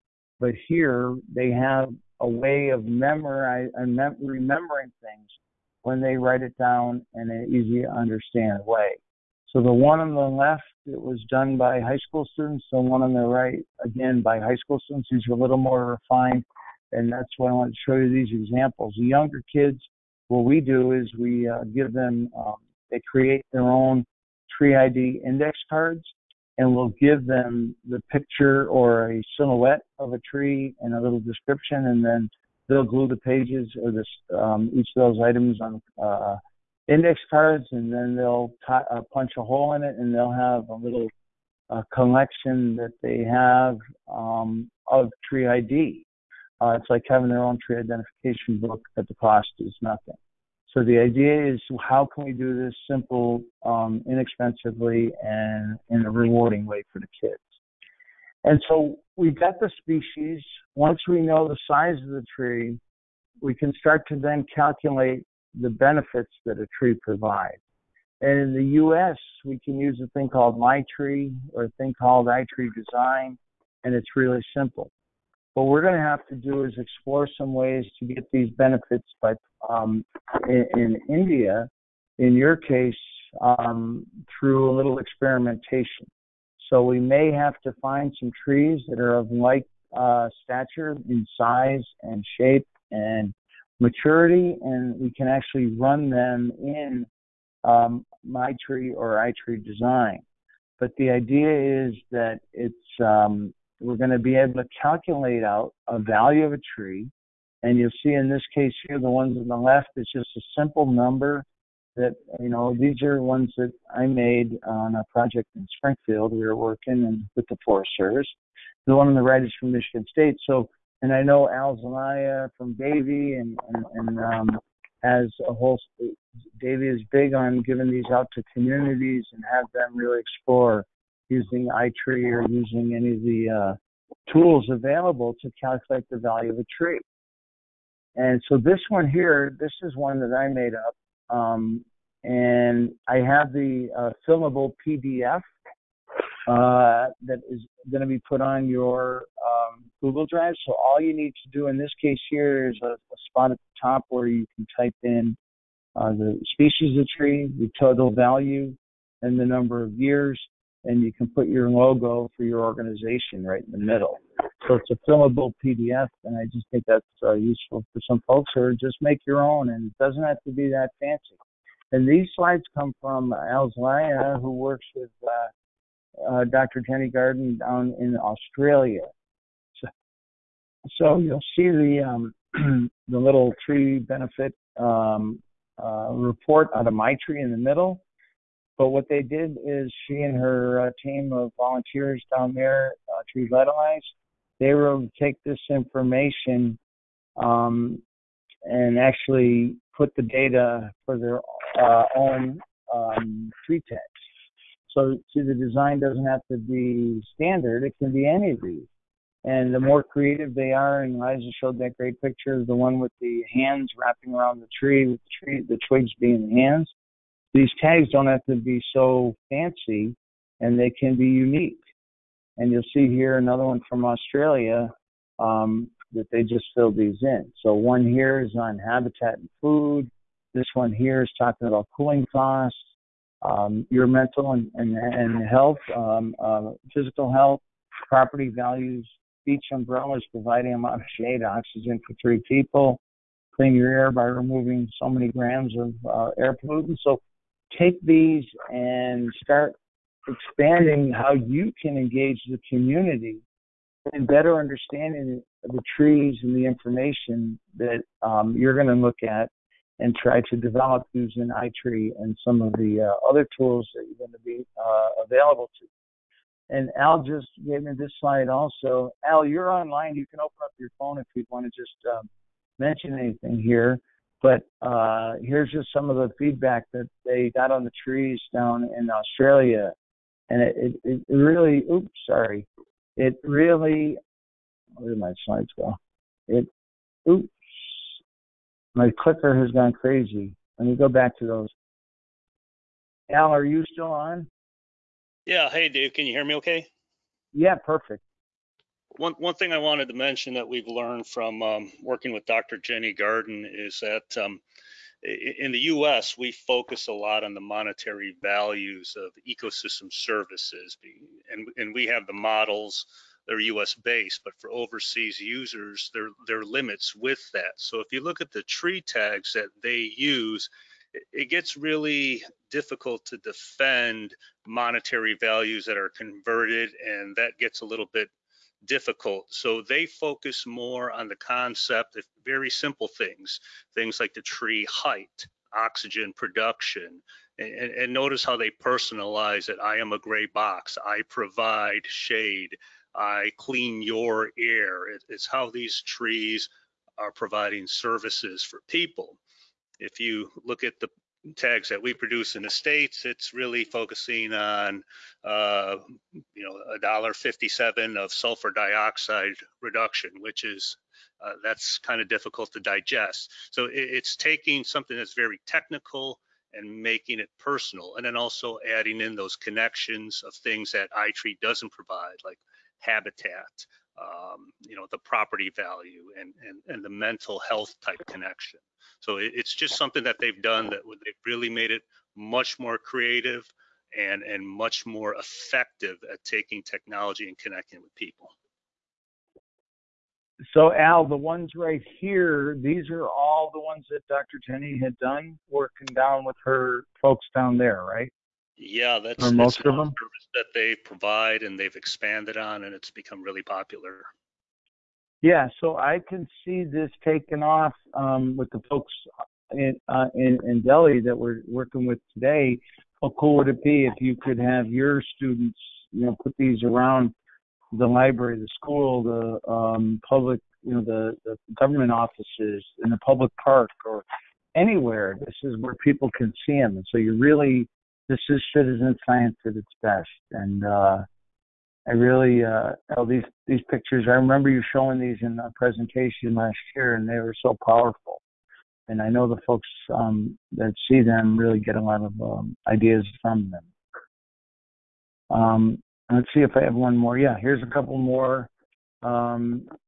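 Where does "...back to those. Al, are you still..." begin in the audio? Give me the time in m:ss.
4:51.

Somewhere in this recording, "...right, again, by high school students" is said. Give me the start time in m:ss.
0:13.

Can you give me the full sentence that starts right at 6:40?
that they provide and they've expanded on and it's become really popular.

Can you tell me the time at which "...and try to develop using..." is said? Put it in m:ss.
4:19.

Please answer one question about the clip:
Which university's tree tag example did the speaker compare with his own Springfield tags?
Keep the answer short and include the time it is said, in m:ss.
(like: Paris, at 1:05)
Michigan State, at 1:59.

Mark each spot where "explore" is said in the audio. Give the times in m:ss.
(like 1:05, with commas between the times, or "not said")
1:16, 2:10.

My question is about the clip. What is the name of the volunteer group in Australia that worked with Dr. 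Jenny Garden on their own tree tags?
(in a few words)
Tree Vitalize.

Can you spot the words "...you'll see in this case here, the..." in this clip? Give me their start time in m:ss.
1:47.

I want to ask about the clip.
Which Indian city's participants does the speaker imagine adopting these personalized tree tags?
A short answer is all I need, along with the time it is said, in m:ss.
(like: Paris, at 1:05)
Delhi, at 6:50.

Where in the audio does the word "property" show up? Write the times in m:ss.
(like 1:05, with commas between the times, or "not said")
3:58, 6:15.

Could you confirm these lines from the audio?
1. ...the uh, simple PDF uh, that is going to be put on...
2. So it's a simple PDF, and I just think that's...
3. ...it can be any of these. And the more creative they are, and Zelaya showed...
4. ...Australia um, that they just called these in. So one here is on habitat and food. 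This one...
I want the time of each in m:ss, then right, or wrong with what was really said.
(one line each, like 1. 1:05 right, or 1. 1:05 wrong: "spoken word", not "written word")
1. 2:23 wrong: "fillable", not "simple"
2. 2:44 wrong: "fillable", not "simple"
3. 3:27 wrong: "Liza", not "Zelaya"
4. 3:44 wrong: "filled", not "called".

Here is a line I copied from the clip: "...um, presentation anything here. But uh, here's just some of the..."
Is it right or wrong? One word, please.
wrong.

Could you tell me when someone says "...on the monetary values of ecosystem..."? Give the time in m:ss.
5:07.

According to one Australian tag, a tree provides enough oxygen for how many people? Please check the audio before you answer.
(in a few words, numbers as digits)
3.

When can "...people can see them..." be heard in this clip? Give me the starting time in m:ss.
7:05.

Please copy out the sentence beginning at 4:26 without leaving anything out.
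And Al just gave me this slide also.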